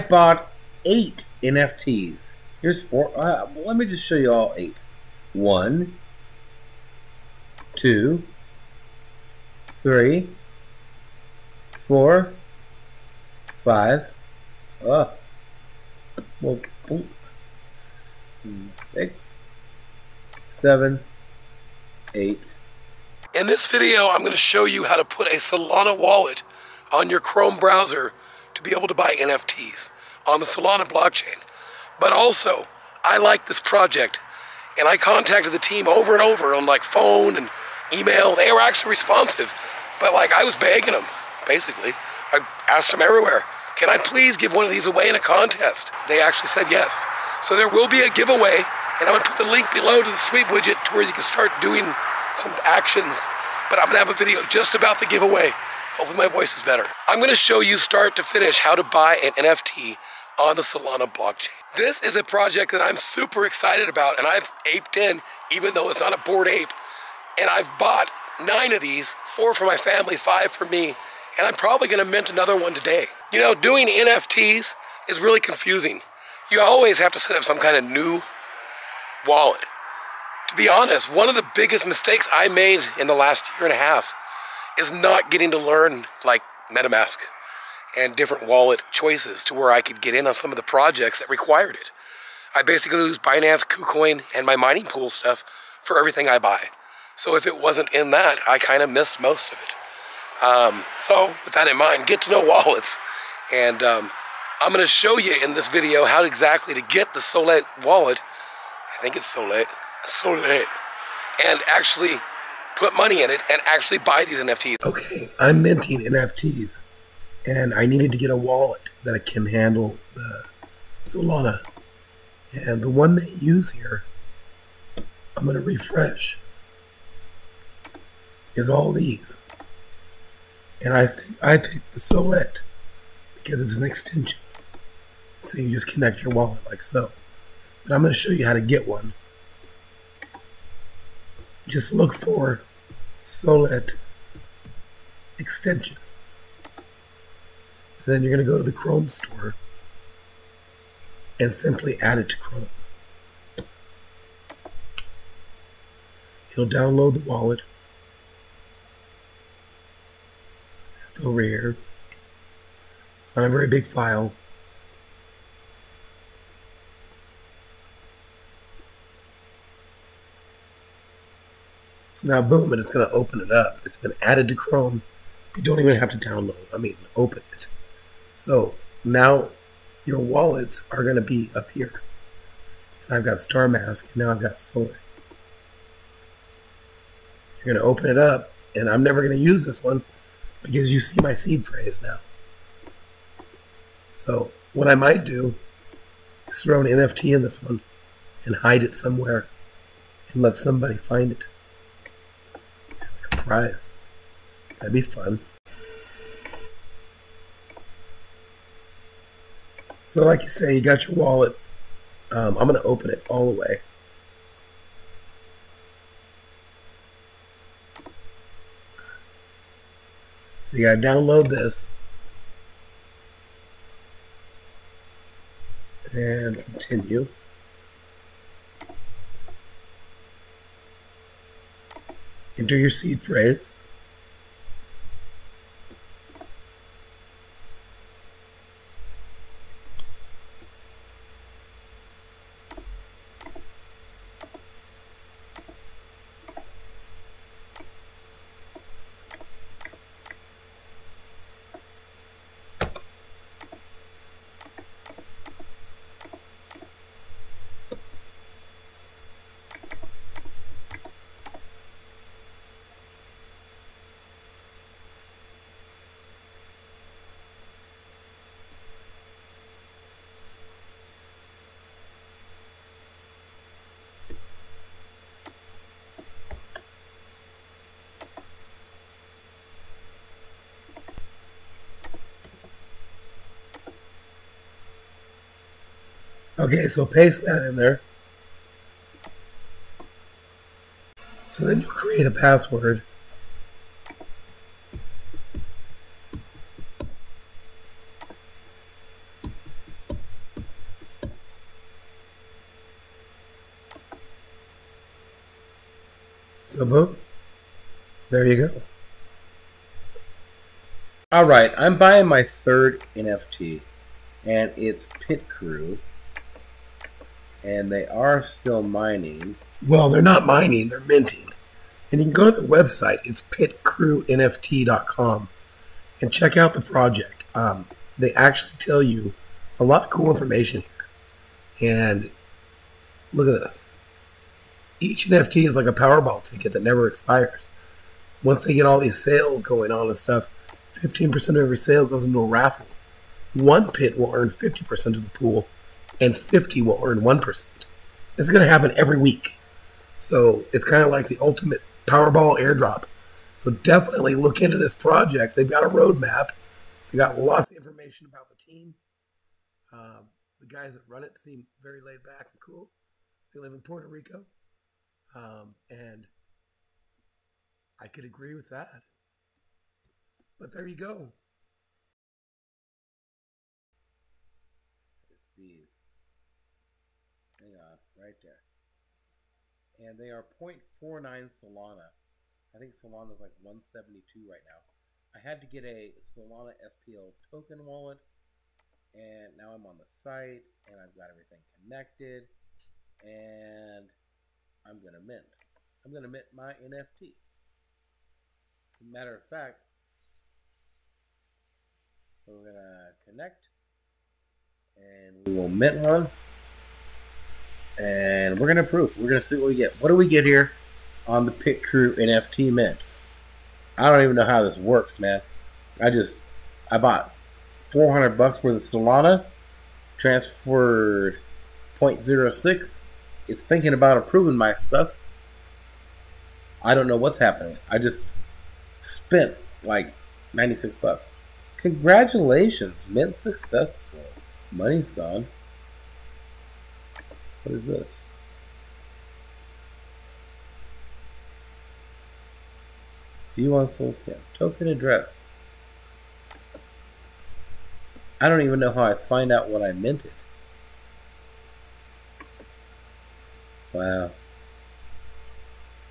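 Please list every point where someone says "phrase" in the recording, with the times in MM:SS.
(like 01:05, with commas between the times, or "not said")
03:11, 03:53.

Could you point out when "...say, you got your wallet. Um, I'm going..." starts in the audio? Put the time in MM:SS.
03:30.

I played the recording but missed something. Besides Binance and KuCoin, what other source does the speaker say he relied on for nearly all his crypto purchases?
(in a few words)
mining pool.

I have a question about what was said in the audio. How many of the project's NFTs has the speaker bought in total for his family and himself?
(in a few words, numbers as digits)
9.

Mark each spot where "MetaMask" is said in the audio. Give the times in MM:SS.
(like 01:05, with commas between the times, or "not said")
01:26.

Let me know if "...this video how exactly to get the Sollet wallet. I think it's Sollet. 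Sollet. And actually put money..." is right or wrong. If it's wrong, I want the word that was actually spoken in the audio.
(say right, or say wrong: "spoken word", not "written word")
right.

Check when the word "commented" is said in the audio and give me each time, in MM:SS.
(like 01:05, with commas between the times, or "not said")
not said.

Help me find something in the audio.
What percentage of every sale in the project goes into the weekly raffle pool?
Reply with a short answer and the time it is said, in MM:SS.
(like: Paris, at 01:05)
15%, at 05:40.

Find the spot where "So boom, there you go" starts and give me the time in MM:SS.
05:06.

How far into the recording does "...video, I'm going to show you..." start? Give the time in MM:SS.
00:23.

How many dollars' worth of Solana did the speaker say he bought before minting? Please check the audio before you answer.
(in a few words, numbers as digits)
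$400.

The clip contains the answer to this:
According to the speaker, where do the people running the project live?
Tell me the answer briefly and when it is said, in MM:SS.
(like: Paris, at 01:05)
Puerto Rico, at 06:03.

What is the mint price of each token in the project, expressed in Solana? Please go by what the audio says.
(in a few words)
0.49 Solana.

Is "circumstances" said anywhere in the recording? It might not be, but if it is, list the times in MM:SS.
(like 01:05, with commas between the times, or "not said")
not said.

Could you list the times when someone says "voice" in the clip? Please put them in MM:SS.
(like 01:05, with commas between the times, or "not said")
00:56.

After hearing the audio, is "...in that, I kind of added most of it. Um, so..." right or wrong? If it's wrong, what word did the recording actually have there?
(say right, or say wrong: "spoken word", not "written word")
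wrong: "missed", not "added".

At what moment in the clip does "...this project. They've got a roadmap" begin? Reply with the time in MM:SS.
05:54.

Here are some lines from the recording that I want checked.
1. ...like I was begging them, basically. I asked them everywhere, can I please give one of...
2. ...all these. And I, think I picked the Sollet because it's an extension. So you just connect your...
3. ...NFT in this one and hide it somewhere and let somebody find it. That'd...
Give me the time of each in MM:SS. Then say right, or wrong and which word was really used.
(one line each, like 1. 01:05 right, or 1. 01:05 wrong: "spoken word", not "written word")
1. 00:40 right
2. 02:08 right
3. 03:16 right.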